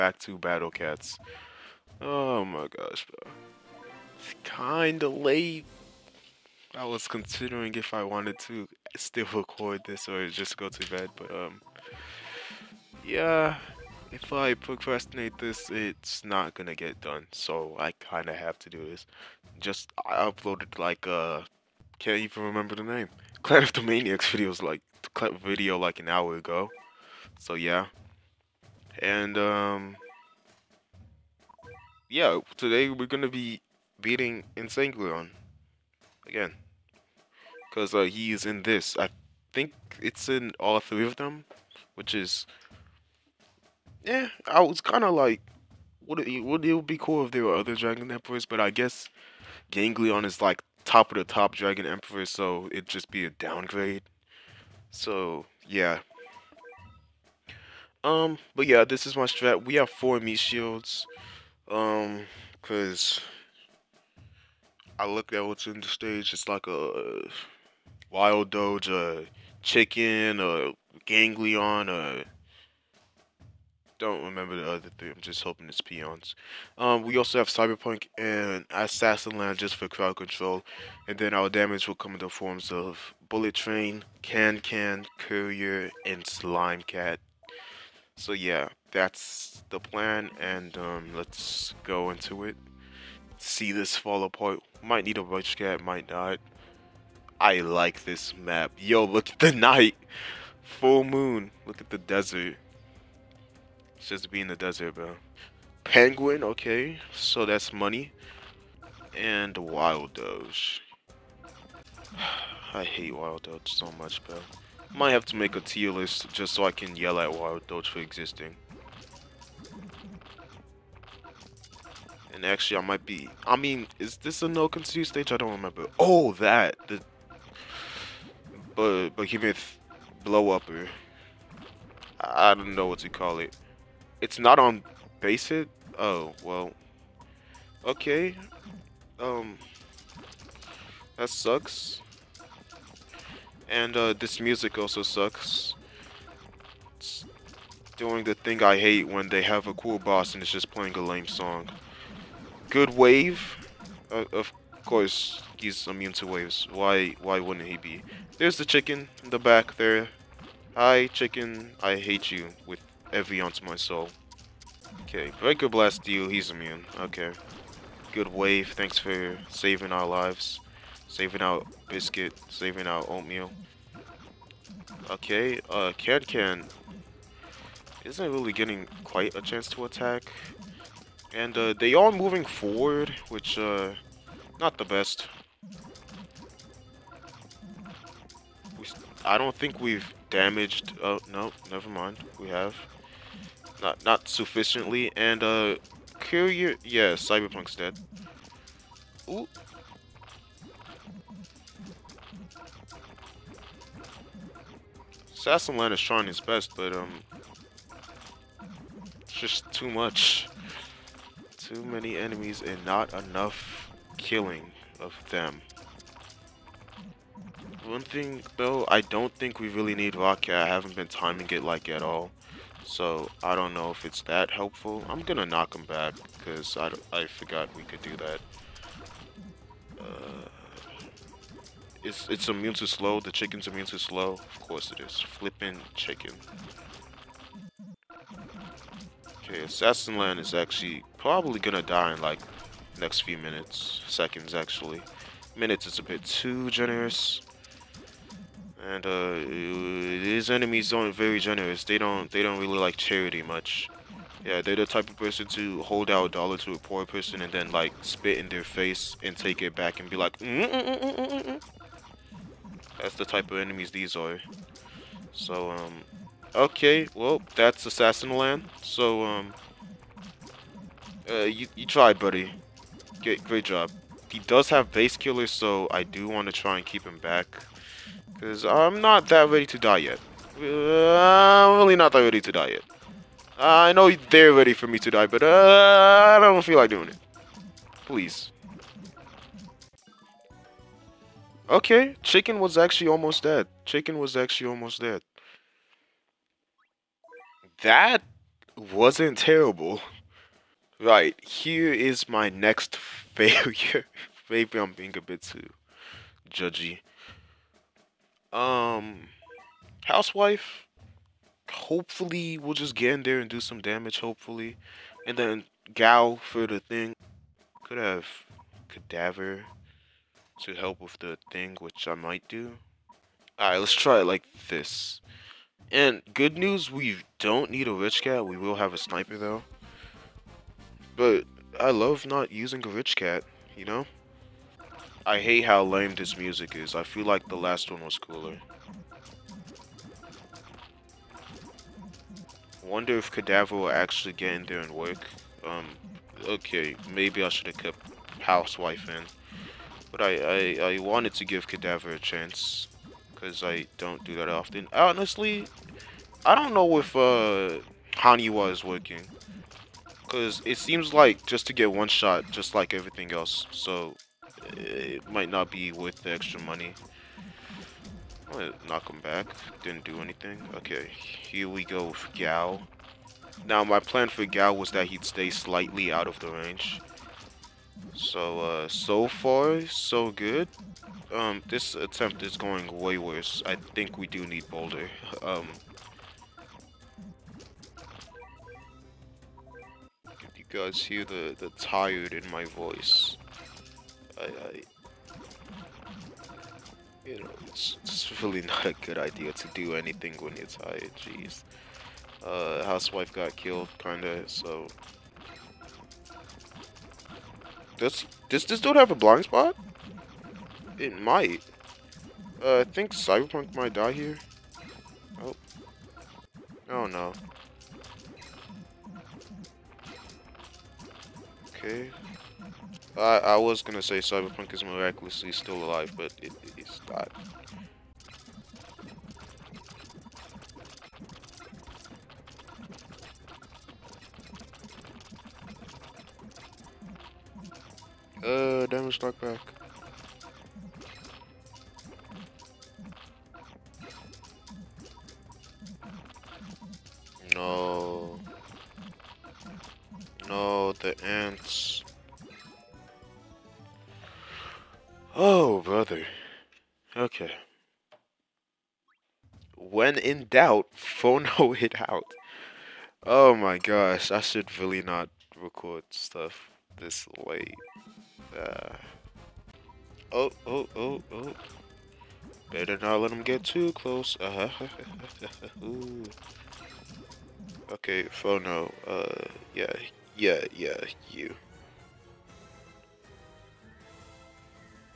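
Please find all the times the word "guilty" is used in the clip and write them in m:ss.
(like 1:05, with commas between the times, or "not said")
not said.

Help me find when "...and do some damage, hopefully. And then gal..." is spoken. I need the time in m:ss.
5:13.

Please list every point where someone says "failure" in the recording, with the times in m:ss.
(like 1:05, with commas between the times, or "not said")
5:02.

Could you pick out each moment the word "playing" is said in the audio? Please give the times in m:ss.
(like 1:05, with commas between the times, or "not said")
2:30.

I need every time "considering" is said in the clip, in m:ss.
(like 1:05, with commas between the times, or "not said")
0:07.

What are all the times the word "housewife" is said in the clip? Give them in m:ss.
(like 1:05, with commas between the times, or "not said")
5:10, 5:48, 6:42.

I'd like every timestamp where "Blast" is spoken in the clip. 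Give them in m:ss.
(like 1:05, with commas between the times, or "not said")
2:45.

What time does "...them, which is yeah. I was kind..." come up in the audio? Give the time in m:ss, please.
0:41.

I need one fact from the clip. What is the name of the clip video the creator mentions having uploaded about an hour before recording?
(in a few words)
Clan of the Maniacs.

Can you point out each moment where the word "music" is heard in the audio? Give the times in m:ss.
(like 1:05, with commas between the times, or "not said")
2:24, 5:36.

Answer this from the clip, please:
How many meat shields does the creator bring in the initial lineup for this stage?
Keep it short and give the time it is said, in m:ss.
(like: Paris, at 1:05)
4, at 0:59.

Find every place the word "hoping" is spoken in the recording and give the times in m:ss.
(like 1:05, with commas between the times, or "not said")
1:15.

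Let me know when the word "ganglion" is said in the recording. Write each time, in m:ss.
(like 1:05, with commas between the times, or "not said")
0:49, 1:11.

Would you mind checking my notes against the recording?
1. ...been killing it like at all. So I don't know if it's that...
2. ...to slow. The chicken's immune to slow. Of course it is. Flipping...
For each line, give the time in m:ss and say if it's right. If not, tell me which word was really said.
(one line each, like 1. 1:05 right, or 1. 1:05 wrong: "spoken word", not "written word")
1. 3:40 wrong: "timing", not "killing"
2. 3:52 right.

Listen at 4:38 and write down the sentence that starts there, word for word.
Because I'm not that ready to die yet.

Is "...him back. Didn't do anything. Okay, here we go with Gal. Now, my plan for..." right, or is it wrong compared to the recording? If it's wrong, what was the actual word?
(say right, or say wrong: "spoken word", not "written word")
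right.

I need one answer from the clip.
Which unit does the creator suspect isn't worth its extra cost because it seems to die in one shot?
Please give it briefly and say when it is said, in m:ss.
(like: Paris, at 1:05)
Haniwa, at 5:58.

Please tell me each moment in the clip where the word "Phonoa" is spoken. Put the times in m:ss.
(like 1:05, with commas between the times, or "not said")
7:40, 7:58.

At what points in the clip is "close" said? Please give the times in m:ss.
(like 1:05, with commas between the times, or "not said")
7:53.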